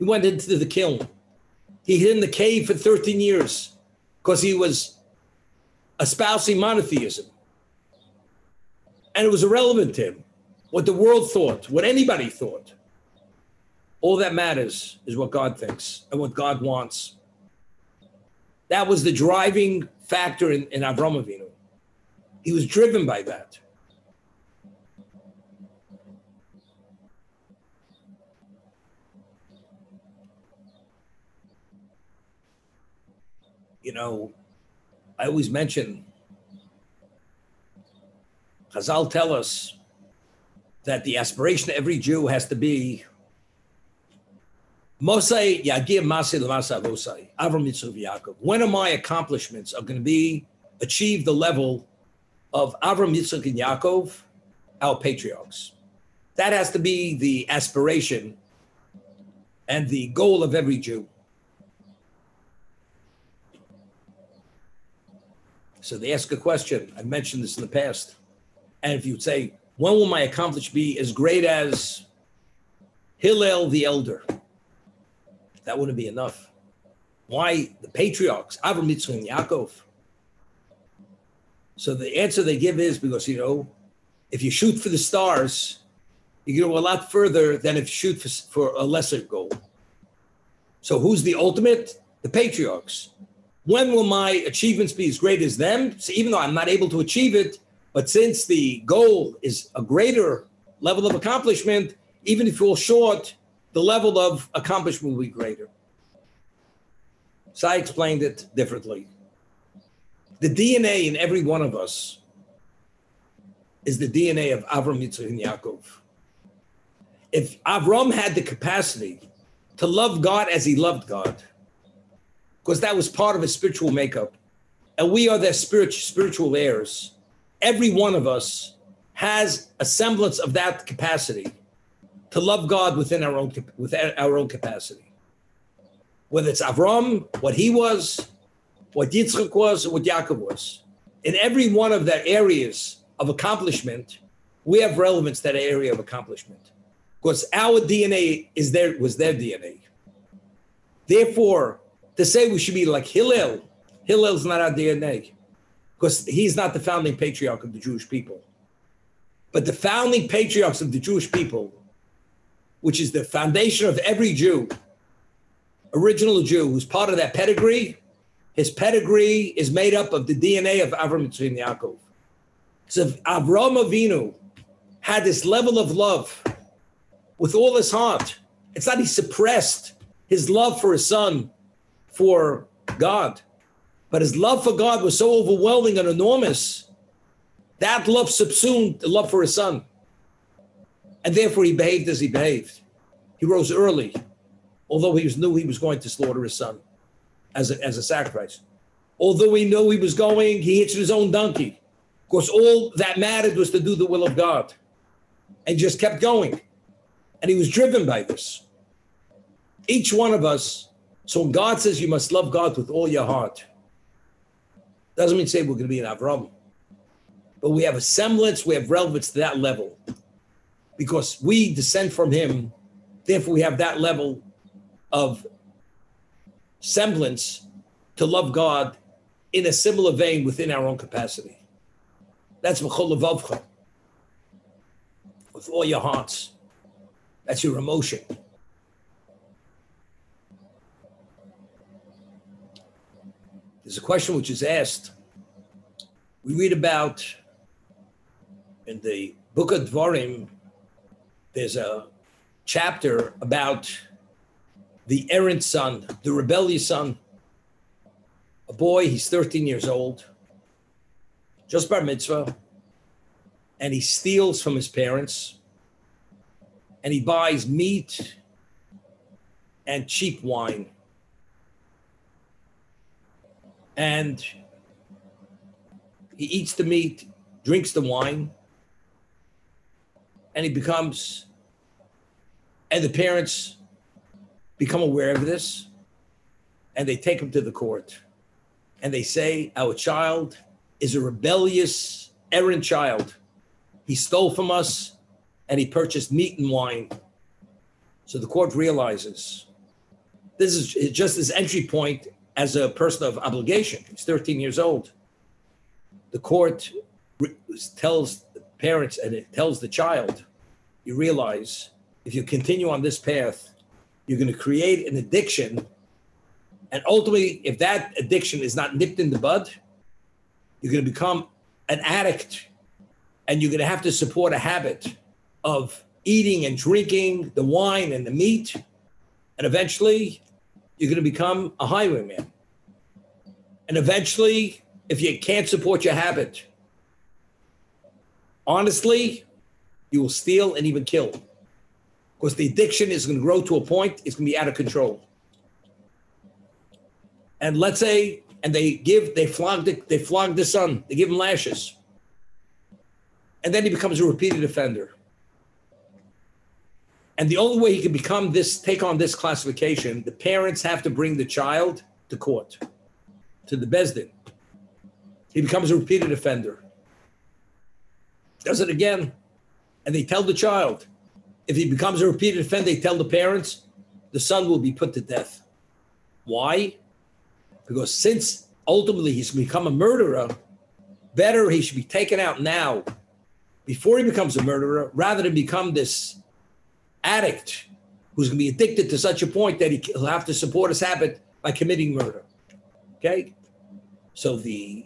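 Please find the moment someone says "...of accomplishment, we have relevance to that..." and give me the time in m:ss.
2:23.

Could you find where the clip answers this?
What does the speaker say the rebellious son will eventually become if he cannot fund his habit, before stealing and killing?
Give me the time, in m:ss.
5:31.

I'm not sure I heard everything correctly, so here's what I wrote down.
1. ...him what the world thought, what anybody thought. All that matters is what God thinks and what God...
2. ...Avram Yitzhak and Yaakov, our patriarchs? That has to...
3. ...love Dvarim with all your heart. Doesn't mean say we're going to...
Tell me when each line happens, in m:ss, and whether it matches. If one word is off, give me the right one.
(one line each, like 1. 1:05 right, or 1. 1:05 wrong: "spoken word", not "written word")
1. 0:10 right
2. 0:52 right
3. 3:32 wrong: "God", not "Dvarim".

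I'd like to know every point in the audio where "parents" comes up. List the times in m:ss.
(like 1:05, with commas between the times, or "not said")
4:24, 4:43, 5:08, 6:00, 6:13.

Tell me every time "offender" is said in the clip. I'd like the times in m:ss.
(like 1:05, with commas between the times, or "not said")
5:54, 6:06, 6:12.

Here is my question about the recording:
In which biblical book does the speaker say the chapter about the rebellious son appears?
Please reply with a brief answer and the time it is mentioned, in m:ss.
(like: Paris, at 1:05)
Dvarim, at 4:09.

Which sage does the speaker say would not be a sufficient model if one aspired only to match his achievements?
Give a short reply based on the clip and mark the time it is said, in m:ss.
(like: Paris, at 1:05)
Hillel the Elder, at 1:13.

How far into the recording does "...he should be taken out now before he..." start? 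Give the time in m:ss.
6:21.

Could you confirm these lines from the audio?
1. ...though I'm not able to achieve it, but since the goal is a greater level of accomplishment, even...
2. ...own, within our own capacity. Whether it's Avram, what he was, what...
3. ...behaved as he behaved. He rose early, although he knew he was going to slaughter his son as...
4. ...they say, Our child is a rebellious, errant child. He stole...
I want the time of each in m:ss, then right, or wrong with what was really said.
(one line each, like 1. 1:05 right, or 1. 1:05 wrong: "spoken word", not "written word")
1. 1:36 right
2. 2:13 right
3. 3:11 right
4. 4:49 right.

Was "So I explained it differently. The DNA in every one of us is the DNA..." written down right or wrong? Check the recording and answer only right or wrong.
right.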